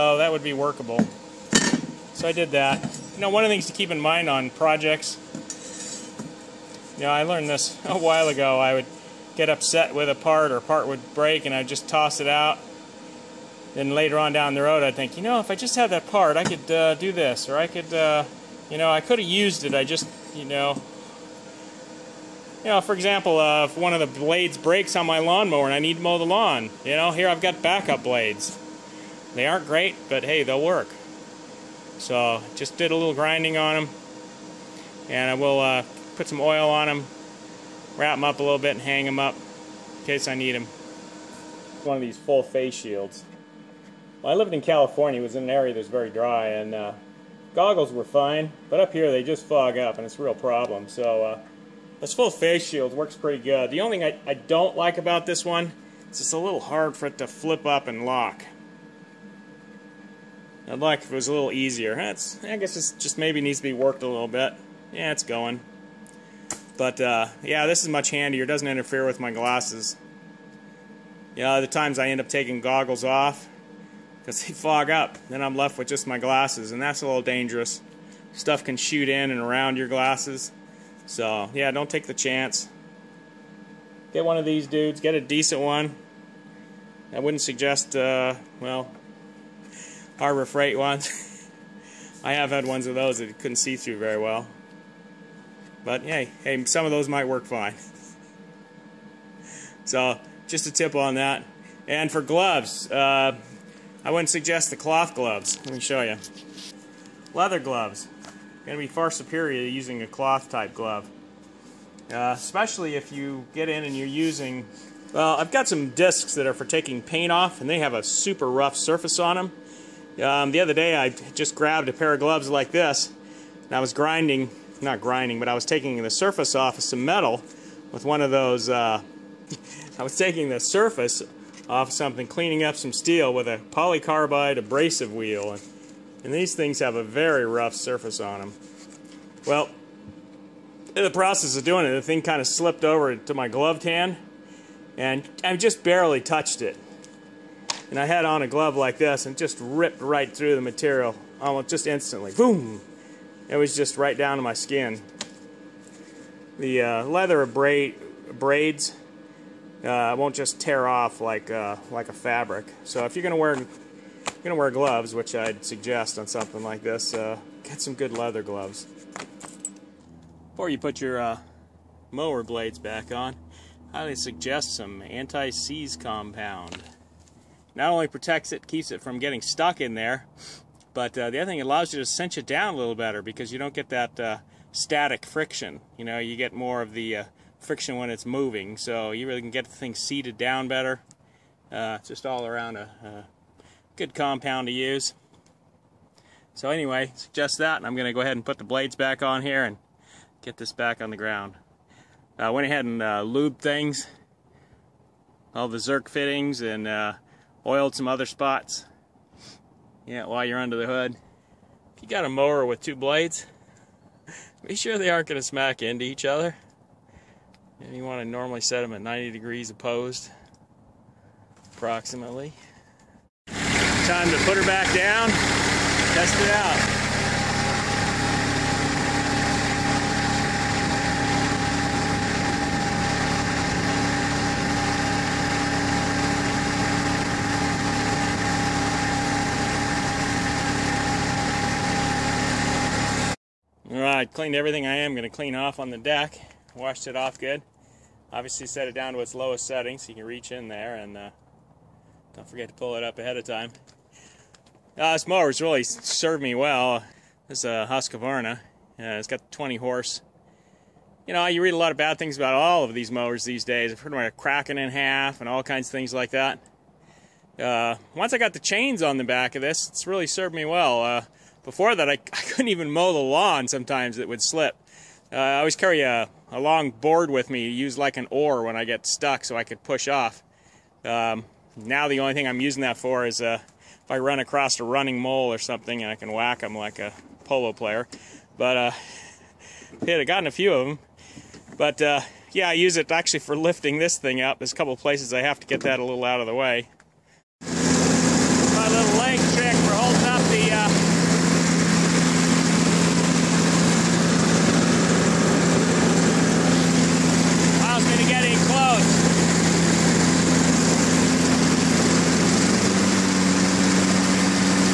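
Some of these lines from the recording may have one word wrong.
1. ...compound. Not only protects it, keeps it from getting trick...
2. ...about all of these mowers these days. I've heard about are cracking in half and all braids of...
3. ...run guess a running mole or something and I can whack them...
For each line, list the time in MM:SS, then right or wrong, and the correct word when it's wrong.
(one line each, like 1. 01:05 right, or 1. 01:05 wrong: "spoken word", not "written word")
1. 02:55 wrong: "stuck", not "trick"
2. 04:22 wrong: "kinds", not "braids"
3. 04:44 wrong: "across", not "guess".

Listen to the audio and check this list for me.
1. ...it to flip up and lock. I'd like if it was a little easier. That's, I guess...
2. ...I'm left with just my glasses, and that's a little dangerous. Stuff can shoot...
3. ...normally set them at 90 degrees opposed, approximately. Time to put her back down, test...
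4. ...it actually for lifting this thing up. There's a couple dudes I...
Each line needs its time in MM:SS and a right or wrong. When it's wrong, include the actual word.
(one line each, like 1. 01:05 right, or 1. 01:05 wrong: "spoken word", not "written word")
1. 00:57 right
2. 01:15 right
3. 03:38 right
4. 04:52 wrong: "places", not "dudes".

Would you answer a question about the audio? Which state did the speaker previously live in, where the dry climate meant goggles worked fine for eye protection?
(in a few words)
California.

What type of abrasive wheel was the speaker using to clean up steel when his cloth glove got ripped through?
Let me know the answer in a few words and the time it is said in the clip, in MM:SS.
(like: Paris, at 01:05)
polycarbide abrasive wheel, at 02:13.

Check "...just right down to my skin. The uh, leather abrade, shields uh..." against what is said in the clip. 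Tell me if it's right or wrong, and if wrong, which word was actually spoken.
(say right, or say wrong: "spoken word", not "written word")
wrong: "braids", not "shields".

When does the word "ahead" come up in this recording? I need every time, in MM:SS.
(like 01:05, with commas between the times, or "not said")
03:18, 03:22, 04:13.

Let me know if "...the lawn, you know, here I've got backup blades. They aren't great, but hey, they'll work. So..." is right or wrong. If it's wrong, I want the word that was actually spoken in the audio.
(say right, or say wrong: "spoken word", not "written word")
right.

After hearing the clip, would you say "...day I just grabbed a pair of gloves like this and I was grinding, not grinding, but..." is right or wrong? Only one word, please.
right.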